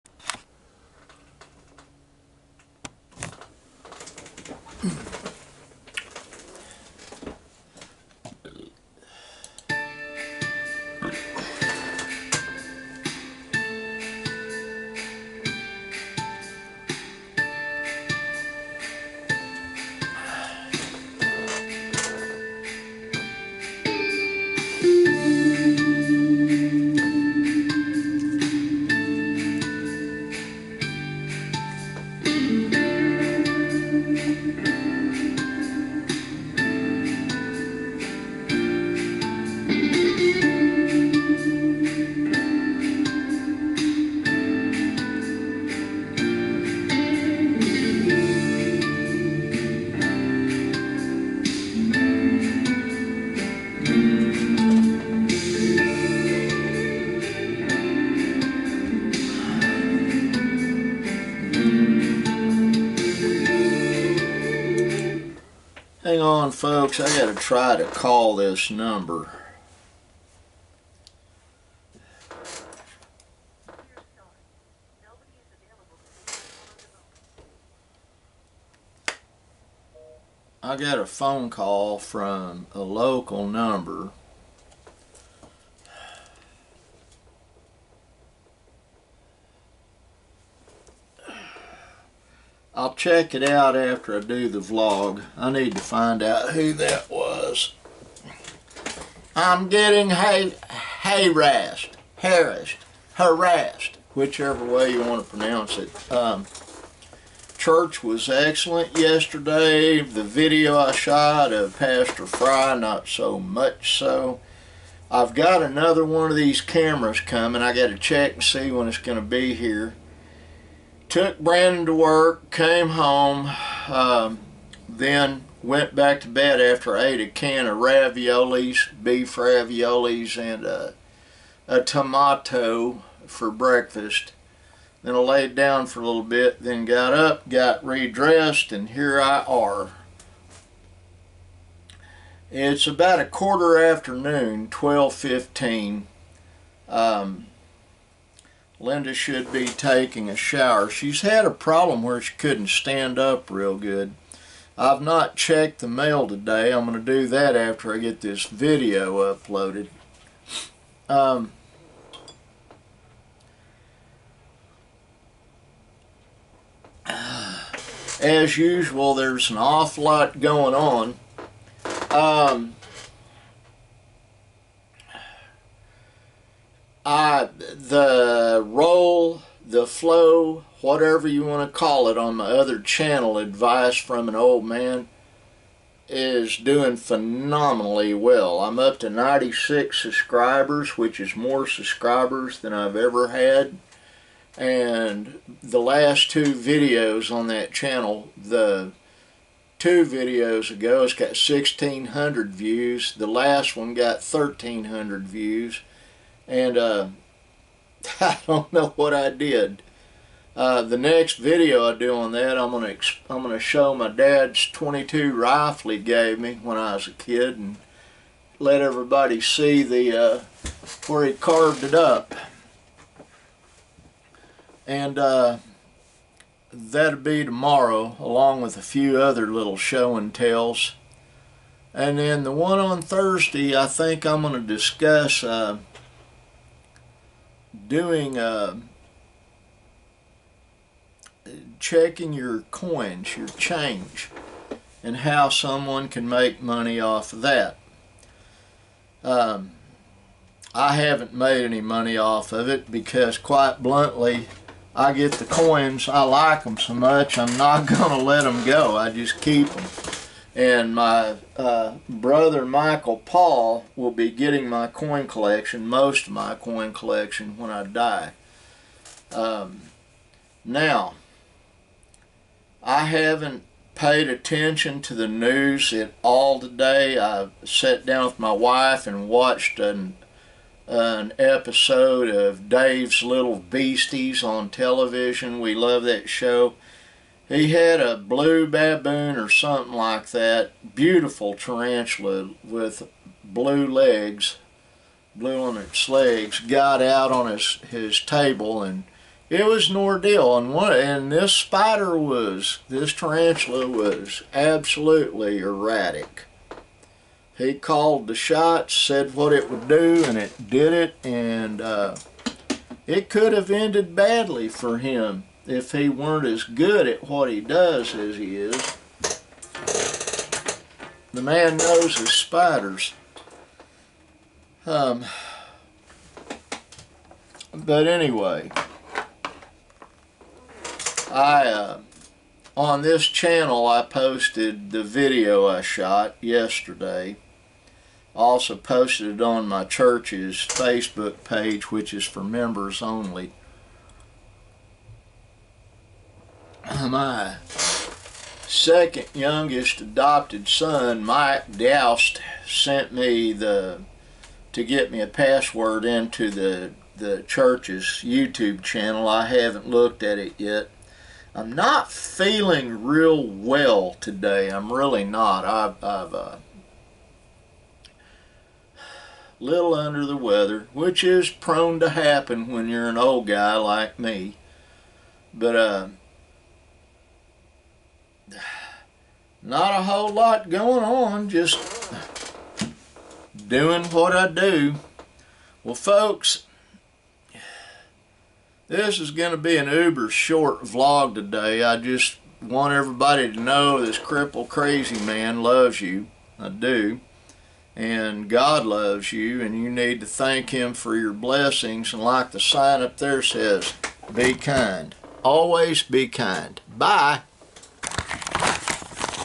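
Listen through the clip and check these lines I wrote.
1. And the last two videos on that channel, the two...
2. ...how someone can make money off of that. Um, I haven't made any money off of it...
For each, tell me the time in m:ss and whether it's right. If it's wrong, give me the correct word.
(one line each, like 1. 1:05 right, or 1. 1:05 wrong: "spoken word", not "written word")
1. 3:14 right
2. 4:05 right.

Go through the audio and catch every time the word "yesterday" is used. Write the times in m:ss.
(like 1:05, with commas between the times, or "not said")
1:48, 5:36.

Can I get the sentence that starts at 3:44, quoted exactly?
And uh, that'll be tomorrow, along with a few other little show and tells.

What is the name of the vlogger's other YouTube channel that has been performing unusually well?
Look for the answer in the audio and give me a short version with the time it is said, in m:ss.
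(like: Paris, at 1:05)
Advice from an Old Man, at 3:03.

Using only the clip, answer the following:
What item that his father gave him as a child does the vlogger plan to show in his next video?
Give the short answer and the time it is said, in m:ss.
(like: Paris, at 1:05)
22 rifle, at 3:34.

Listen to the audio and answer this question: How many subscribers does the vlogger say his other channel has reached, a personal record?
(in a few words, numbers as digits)
96.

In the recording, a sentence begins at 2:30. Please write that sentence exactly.
She's had a problem where she couldn't stand up real good.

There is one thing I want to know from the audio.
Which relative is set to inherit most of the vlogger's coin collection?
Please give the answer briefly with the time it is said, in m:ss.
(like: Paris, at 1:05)
Michael Paul, at 4:22.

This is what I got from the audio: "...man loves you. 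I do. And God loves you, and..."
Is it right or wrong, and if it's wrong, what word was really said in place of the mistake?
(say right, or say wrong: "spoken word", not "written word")
right.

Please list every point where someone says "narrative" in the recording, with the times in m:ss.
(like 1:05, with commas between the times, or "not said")
not said.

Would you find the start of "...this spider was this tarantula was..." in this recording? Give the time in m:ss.
5:01.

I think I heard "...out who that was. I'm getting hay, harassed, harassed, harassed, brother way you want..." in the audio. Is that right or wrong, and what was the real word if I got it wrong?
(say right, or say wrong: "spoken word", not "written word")
wrong: "whichever", not "brother".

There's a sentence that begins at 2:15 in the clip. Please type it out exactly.
Then I laid down for a little bit, then got up, got redressed, and here I are.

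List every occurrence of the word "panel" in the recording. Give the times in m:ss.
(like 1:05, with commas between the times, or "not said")
not said.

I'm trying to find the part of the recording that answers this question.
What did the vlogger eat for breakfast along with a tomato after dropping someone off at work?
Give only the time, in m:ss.
2:09.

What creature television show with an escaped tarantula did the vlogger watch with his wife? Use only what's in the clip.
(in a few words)
Dave's Little Beasties.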